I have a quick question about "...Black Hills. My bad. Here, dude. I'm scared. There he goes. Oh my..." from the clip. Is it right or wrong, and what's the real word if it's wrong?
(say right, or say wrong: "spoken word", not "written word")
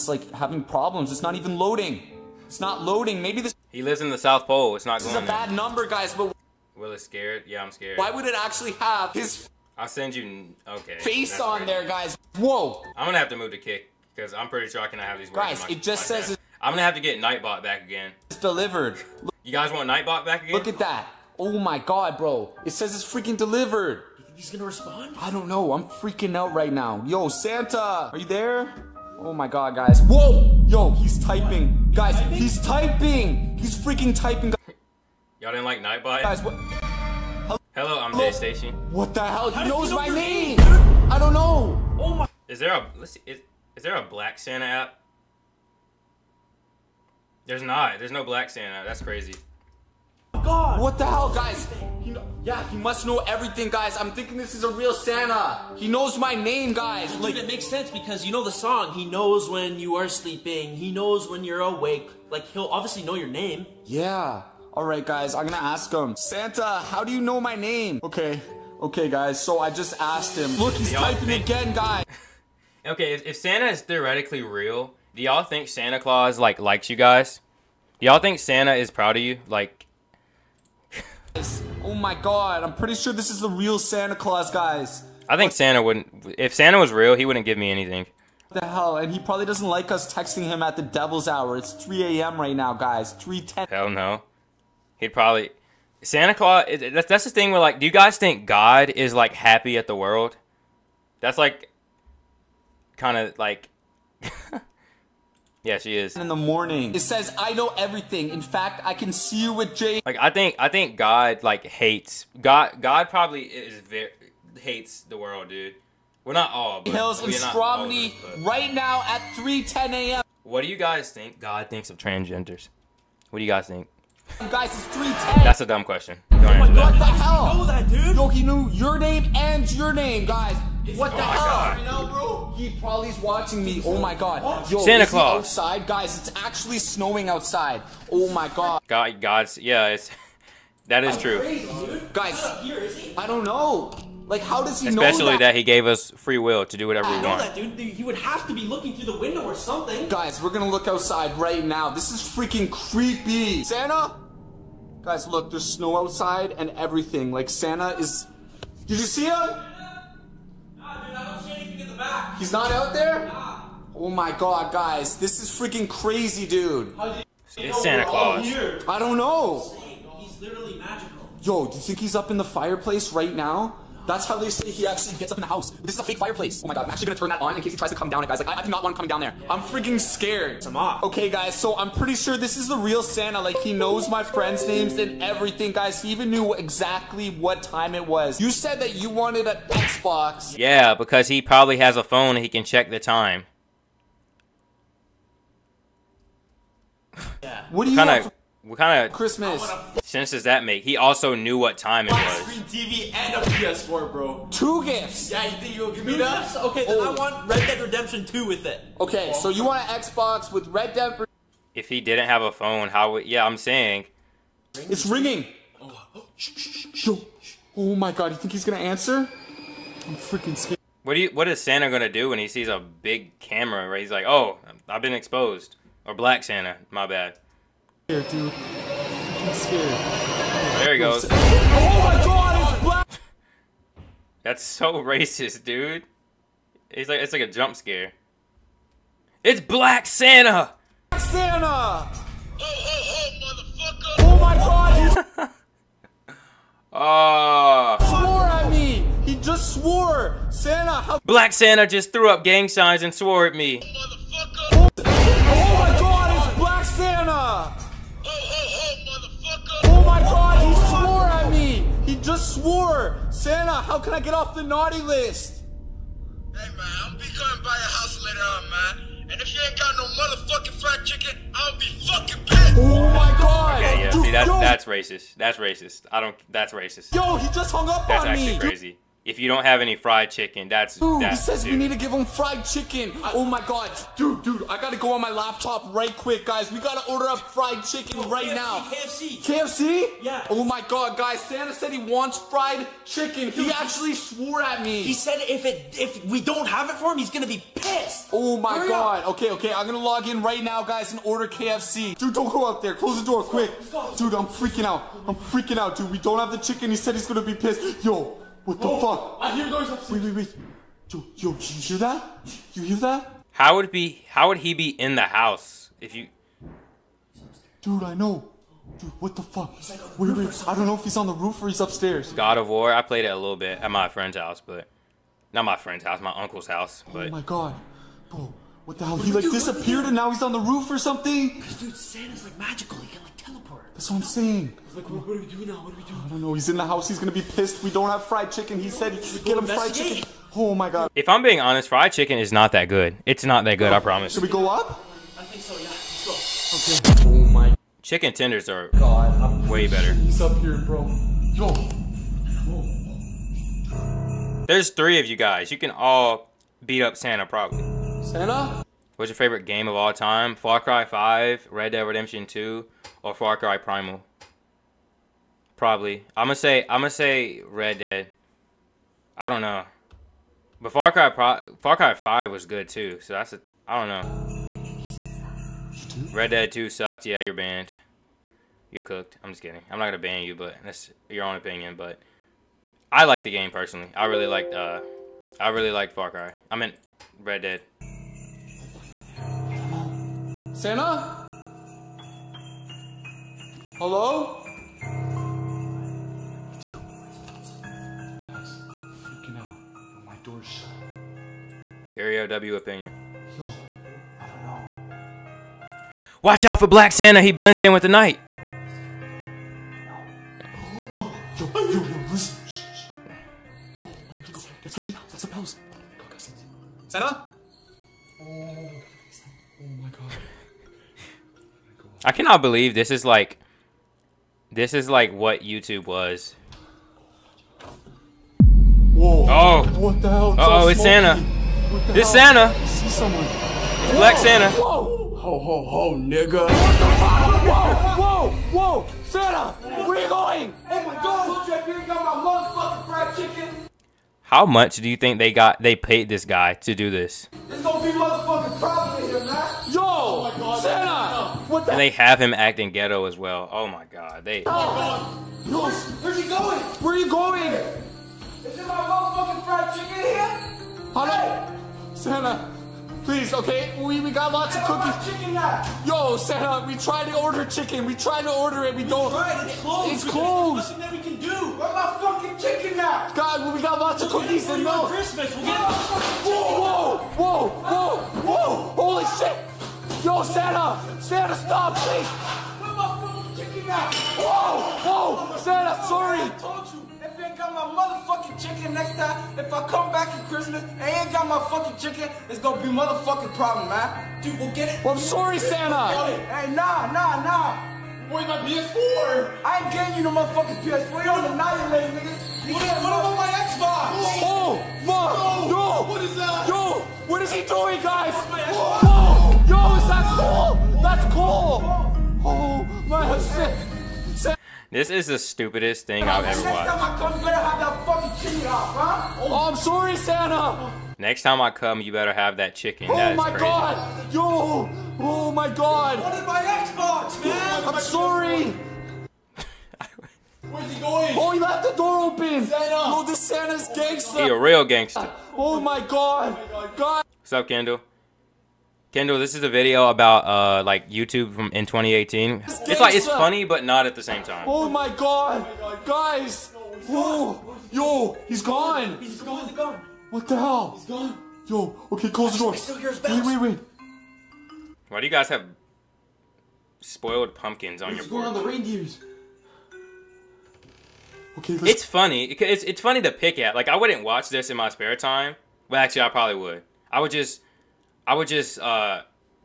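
wrong: "Santa", not "Hills".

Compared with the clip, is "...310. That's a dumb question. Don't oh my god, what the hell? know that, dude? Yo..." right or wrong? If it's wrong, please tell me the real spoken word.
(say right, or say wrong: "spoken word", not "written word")
right.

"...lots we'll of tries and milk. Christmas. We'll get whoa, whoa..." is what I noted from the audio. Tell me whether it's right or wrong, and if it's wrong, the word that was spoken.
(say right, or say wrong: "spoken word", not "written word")
wrong: "cookies", not "tries".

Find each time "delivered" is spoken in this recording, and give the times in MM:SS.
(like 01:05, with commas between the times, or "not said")
00:18, 00:23.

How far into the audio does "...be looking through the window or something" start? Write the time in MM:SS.
02:28.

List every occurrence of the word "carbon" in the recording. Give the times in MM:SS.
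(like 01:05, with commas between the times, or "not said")
not said.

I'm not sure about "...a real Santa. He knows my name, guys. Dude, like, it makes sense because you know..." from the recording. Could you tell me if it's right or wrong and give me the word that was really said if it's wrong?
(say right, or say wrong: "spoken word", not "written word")
right.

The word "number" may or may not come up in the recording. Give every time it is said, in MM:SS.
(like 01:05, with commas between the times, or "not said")
00:05.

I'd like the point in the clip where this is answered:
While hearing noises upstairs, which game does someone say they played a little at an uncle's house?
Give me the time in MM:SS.
05:22.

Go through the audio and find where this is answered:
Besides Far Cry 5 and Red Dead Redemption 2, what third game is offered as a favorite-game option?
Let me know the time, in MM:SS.
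06:03.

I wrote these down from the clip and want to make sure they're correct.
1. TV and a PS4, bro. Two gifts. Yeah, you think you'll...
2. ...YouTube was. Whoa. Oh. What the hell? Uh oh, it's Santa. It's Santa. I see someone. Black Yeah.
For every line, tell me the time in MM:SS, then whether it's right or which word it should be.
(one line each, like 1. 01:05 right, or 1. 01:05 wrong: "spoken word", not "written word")
1. 03:22 right
2. 07:05 wrong: "Santa", not "Yeah".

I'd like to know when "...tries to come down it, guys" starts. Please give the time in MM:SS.
02:57.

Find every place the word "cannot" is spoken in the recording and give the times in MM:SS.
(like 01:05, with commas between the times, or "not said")
00:14, 07:02.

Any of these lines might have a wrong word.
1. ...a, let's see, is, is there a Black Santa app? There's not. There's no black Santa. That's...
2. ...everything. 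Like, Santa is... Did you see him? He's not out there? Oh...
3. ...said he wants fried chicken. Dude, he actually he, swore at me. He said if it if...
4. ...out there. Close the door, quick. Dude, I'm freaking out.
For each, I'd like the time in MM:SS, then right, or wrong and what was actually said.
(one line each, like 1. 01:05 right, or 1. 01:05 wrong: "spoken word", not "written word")
1. 00:42 right
2. 02:36 right
3. 04:51 right
4. 05:02 right.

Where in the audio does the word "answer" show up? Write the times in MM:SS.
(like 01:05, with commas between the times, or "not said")
03:38.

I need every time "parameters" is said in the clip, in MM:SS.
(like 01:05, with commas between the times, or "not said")
not said.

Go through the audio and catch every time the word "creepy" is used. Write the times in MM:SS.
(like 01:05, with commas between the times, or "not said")
02:32.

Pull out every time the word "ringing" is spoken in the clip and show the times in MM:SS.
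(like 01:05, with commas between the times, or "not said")
03:35.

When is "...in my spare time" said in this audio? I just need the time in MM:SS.
09:24.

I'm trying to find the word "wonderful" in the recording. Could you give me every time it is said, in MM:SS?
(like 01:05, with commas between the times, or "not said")
not said.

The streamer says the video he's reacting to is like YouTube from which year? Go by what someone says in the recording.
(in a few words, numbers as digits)
2018.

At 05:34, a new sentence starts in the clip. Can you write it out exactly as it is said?
Like, what, what we doing now?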